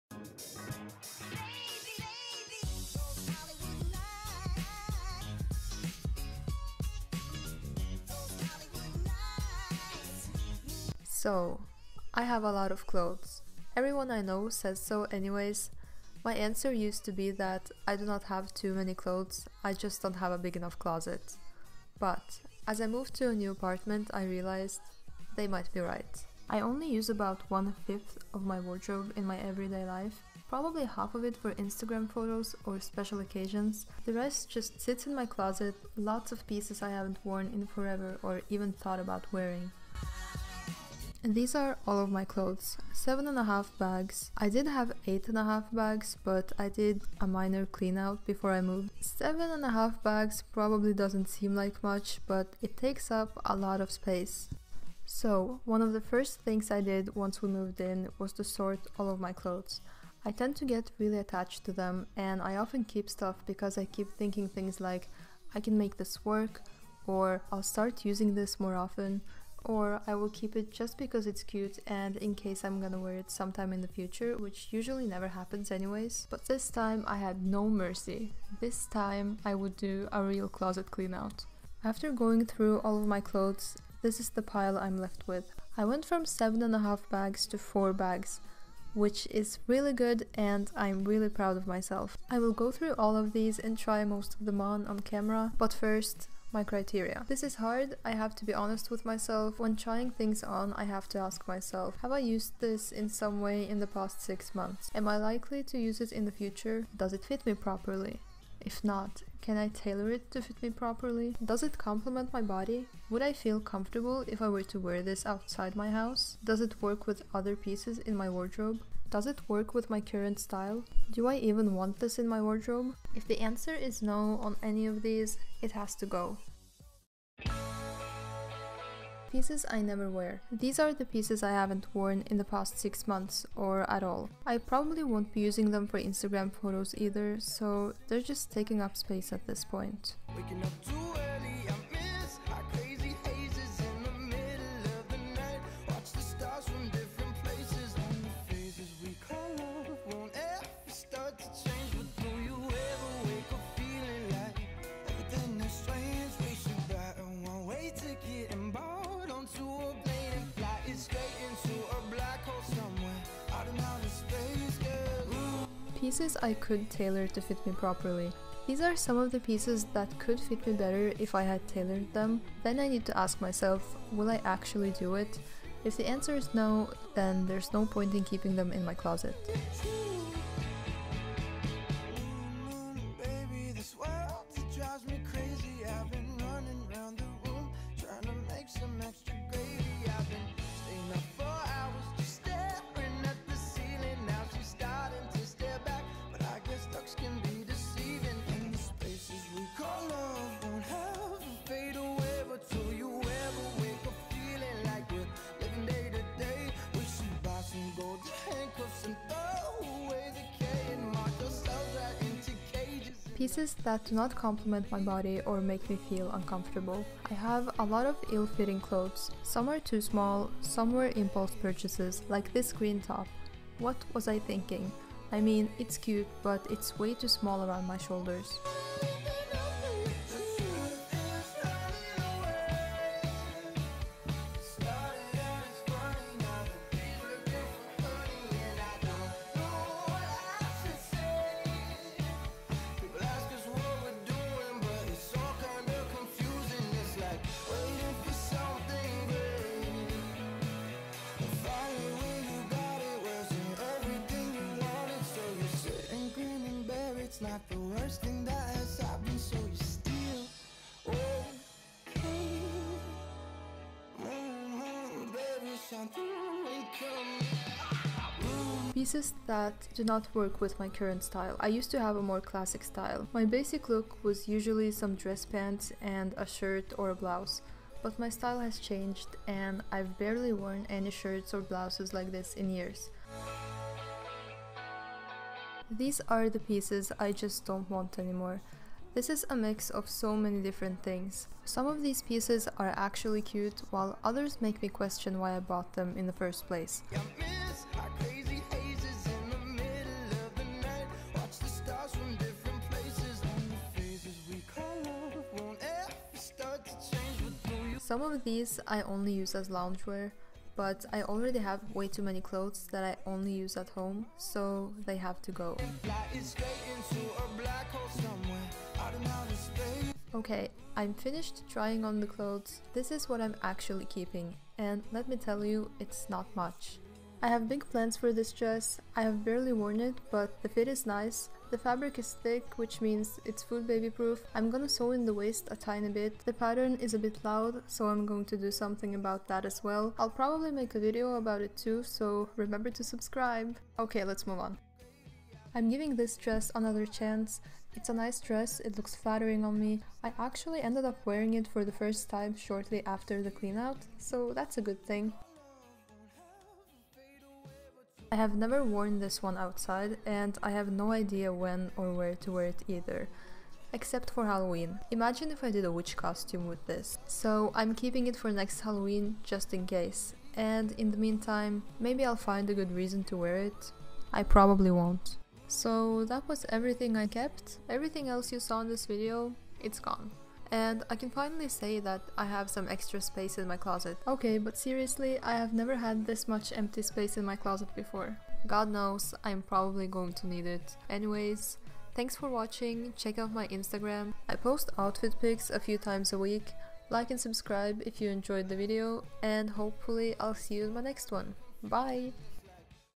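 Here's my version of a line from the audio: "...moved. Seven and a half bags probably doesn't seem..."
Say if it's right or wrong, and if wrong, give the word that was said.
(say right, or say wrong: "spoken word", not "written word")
right.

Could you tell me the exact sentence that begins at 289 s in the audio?
This is a mix of so many different things.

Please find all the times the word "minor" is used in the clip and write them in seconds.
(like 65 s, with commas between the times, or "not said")
47 s.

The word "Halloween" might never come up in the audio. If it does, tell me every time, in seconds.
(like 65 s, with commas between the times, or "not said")
364 s, 368 s.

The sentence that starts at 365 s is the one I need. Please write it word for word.
Imagine if I did a witch costume with this.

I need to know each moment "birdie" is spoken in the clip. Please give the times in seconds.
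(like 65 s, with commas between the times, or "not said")
not said.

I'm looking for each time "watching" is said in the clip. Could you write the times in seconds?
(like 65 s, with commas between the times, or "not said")
392 s.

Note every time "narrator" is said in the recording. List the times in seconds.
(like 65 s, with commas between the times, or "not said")
not said.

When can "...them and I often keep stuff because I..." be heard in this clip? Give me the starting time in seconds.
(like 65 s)
61 s.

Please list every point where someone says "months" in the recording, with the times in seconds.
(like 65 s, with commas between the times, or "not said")
104 s, 133 s.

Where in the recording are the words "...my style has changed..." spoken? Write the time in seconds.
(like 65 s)
278 s.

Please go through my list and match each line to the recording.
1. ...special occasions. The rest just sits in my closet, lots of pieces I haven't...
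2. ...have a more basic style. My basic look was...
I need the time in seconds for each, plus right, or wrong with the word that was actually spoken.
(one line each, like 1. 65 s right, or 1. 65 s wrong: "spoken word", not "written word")
1. 32 s right
2. 271 s wrong: "classic", not "basic".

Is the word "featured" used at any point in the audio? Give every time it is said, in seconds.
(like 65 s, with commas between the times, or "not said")
not said.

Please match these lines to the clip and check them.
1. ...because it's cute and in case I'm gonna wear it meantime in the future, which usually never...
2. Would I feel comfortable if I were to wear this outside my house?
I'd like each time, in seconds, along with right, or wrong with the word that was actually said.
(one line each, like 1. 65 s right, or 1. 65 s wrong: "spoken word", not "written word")
1. 70 s wrong: "sometime", not "meantime"
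2. 113 s right.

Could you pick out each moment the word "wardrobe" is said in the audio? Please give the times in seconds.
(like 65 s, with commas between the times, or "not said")
28 s, 118 s, 122 s.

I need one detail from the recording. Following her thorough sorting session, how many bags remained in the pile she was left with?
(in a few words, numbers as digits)
4 bags.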